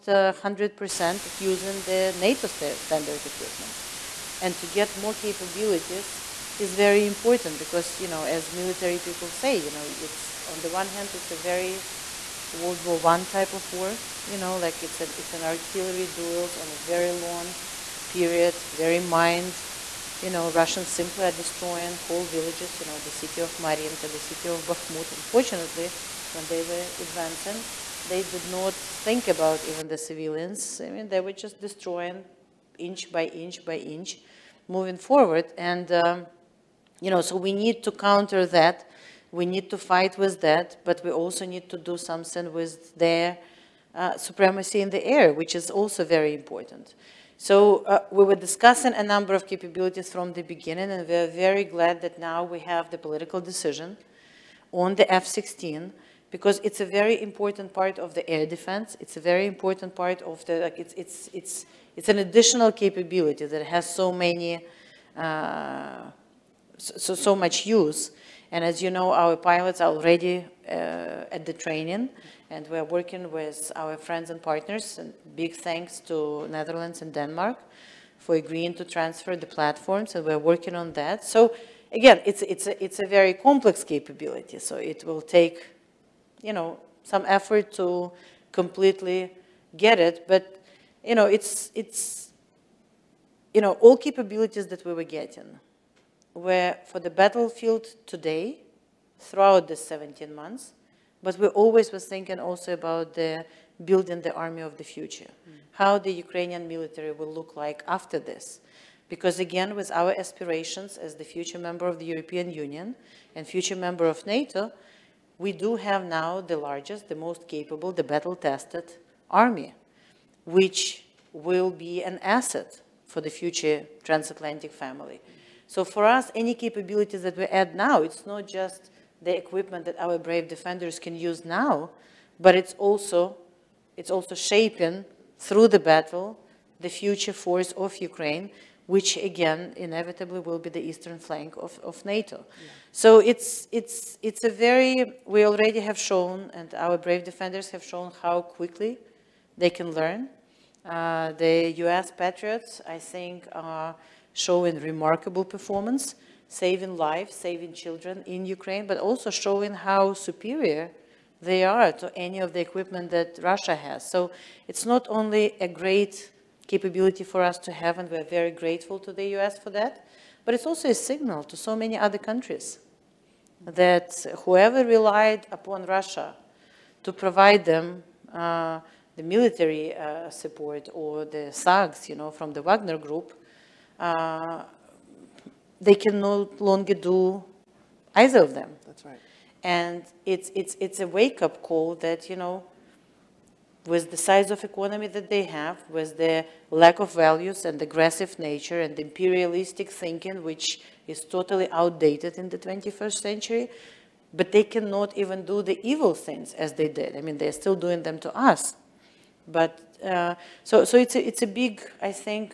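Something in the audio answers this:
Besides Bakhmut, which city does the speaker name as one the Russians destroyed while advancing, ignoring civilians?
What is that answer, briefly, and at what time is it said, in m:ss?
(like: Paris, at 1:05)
Mariinka, at 0:22.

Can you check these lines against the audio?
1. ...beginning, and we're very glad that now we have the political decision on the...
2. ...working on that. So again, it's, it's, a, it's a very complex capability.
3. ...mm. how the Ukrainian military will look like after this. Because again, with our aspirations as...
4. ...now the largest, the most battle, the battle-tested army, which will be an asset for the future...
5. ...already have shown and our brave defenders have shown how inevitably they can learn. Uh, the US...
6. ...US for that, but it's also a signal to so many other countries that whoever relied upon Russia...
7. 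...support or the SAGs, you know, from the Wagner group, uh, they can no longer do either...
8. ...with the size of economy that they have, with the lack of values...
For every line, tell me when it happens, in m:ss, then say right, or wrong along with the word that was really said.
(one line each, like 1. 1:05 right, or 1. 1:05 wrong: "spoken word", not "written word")
1. 0:50 right
2. 1:20 right
3. 1:45 right
4. 1:56 wrong: "capable", not "battle"
5. 2:25 wrong: "quickly", not "inevitably"
6. 2:49 right
7. 3:00 right
8. 3:13 right.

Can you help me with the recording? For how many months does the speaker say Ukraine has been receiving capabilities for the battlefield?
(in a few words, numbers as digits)
17 months.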